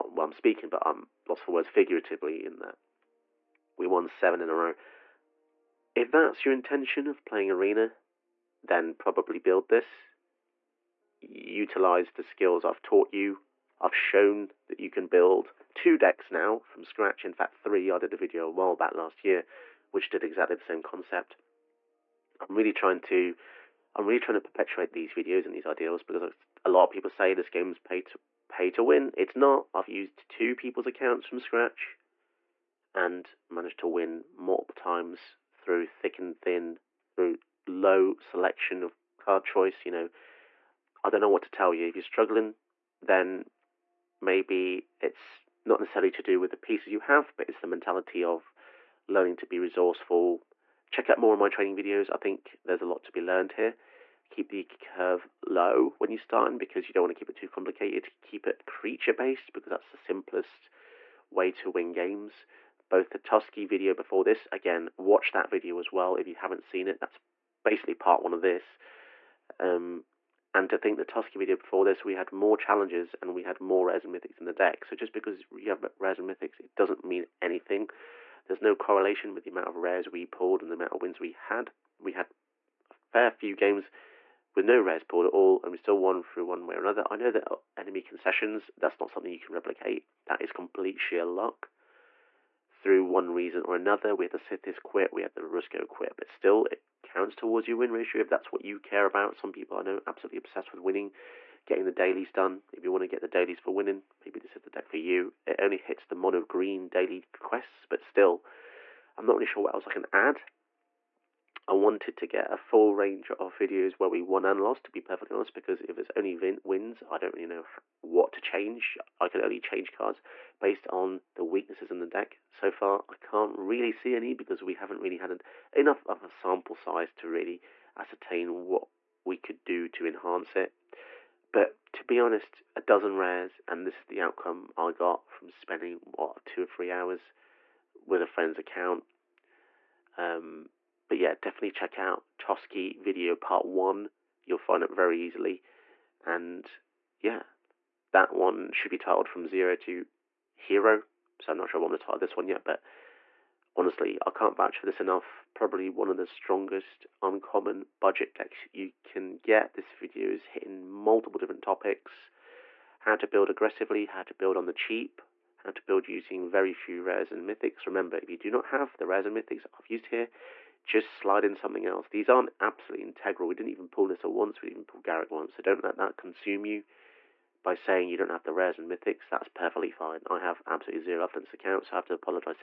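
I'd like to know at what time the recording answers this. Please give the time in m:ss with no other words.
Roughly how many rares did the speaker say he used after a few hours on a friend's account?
2:12.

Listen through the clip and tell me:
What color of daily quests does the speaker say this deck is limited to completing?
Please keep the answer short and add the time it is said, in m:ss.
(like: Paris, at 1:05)
mono green, at 1:46.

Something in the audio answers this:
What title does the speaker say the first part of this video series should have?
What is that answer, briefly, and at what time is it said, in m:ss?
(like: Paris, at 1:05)
From Zero to Hero, at 2:29.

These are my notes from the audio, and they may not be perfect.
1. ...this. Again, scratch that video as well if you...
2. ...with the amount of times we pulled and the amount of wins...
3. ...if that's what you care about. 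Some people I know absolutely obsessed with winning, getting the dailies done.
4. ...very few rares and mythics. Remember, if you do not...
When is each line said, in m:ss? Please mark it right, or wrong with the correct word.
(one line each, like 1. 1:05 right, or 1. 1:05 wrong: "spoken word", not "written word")
1. 1:04 wrong: "watch", not "scratch"
2. 1:19 wrong: "rares", not "times"
3. 1:38 right
4. 2:46 right.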